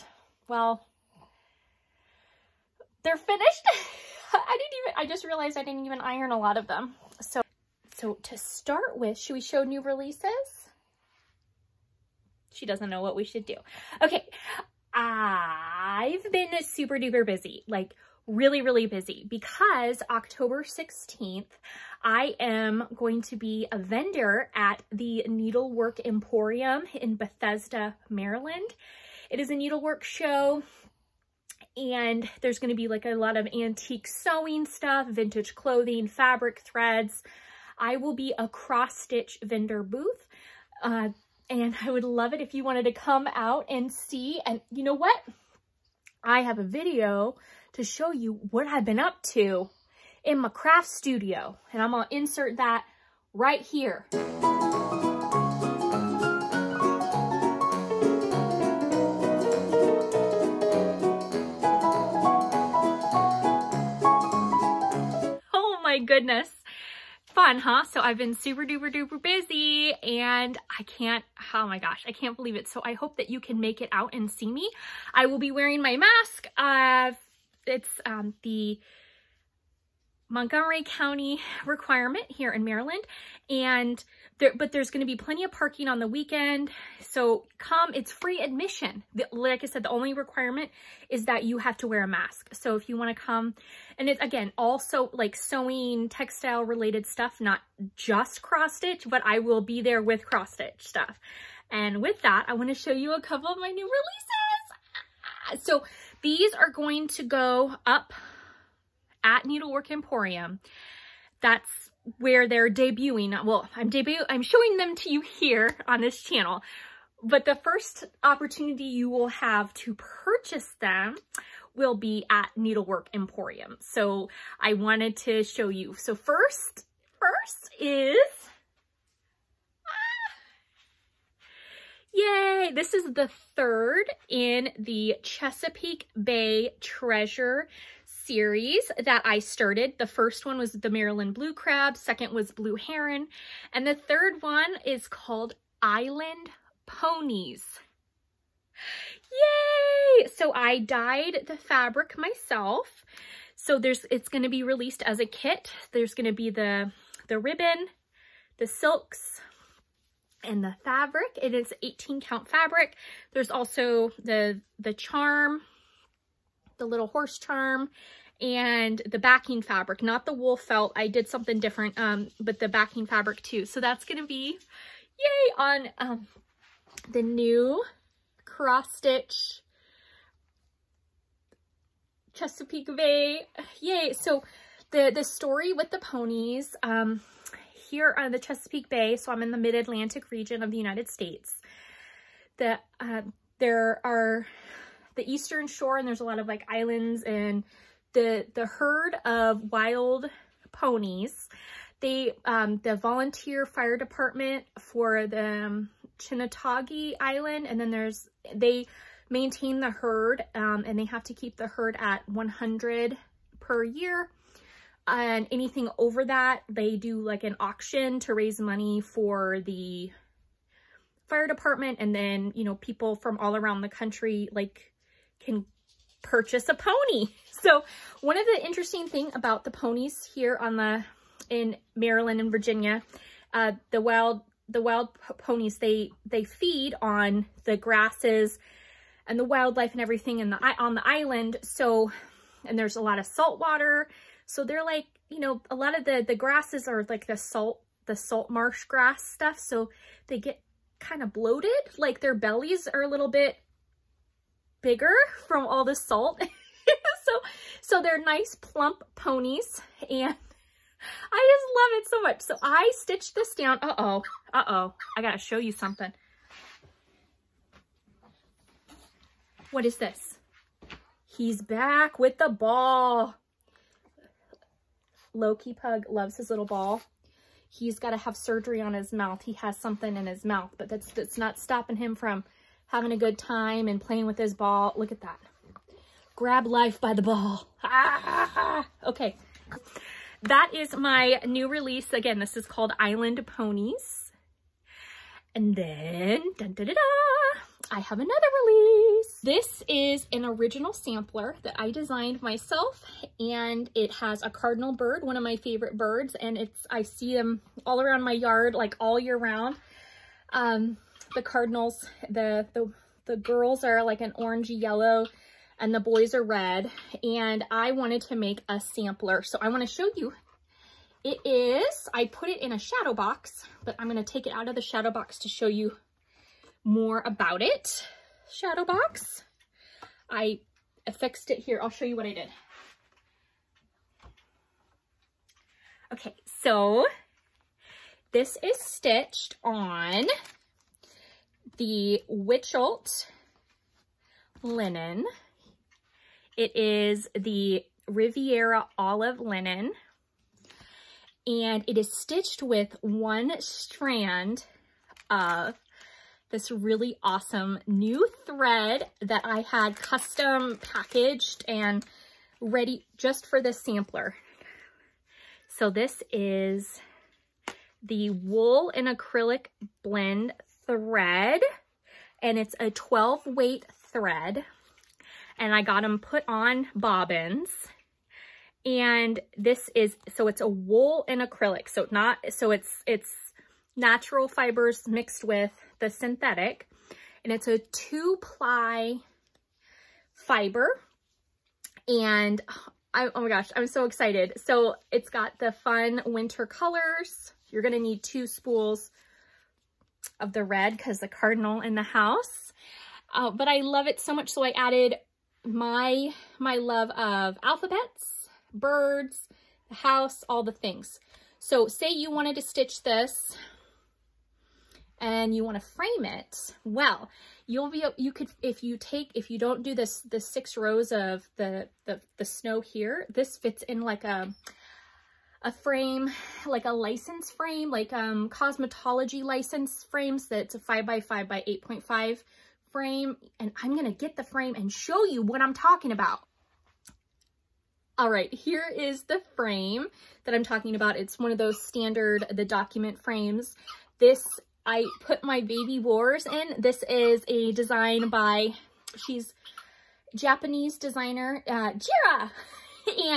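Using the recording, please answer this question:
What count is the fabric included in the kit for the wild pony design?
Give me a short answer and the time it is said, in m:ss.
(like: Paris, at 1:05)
18 count, at 2:41.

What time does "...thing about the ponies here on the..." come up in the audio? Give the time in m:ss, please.
3:49.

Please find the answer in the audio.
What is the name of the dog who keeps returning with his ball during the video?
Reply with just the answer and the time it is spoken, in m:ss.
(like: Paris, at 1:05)
Loki, at 4:35.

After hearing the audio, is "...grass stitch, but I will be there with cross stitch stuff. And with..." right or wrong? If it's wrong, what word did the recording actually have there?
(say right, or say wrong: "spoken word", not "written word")
wrong: "cross", not "grass".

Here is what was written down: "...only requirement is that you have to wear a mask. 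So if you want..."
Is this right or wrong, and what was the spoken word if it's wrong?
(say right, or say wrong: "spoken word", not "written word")
right.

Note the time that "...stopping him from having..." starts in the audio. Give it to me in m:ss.
4:41.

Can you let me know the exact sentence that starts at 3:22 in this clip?
They, um, the volunteer fire department for the um, Chincoteague Island.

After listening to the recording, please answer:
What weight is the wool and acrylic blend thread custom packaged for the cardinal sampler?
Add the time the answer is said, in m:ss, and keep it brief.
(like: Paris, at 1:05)
12 weight, at 6:12.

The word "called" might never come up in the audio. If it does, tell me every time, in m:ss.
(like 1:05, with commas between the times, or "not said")
2:25, 4:52.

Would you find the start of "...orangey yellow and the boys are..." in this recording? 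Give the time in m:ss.
5:14.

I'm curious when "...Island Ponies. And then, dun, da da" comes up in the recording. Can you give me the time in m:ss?
4:52.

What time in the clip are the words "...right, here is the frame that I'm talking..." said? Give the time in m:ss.
7:18.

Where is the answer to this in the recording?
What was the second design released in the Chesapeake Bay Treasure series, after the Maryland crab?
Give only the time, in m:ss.
2:22.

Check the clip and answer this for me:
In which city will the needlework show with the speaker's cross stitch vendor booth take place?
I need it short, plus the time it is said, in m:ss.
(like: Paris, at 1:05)
Bethesda, Maryland, at 0:27.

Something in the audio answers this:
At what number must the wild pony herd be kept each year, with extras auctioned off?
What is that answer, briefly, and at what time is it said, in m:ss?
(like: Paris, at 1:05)
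100, at 3:32.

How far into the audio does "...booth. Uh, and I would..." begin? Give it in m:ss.
0:39.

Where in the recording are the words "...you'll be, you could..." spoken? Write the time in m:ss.
6:57.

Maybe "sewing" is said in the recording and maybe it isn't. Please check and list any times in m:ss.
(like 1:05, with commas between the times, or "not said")
0:34, 1:35.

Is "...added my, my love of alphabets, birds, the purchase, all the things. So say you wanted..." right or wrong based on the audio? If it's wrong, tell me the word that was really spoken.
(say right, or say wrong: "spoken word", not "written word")
wrong: "house", not "purchase".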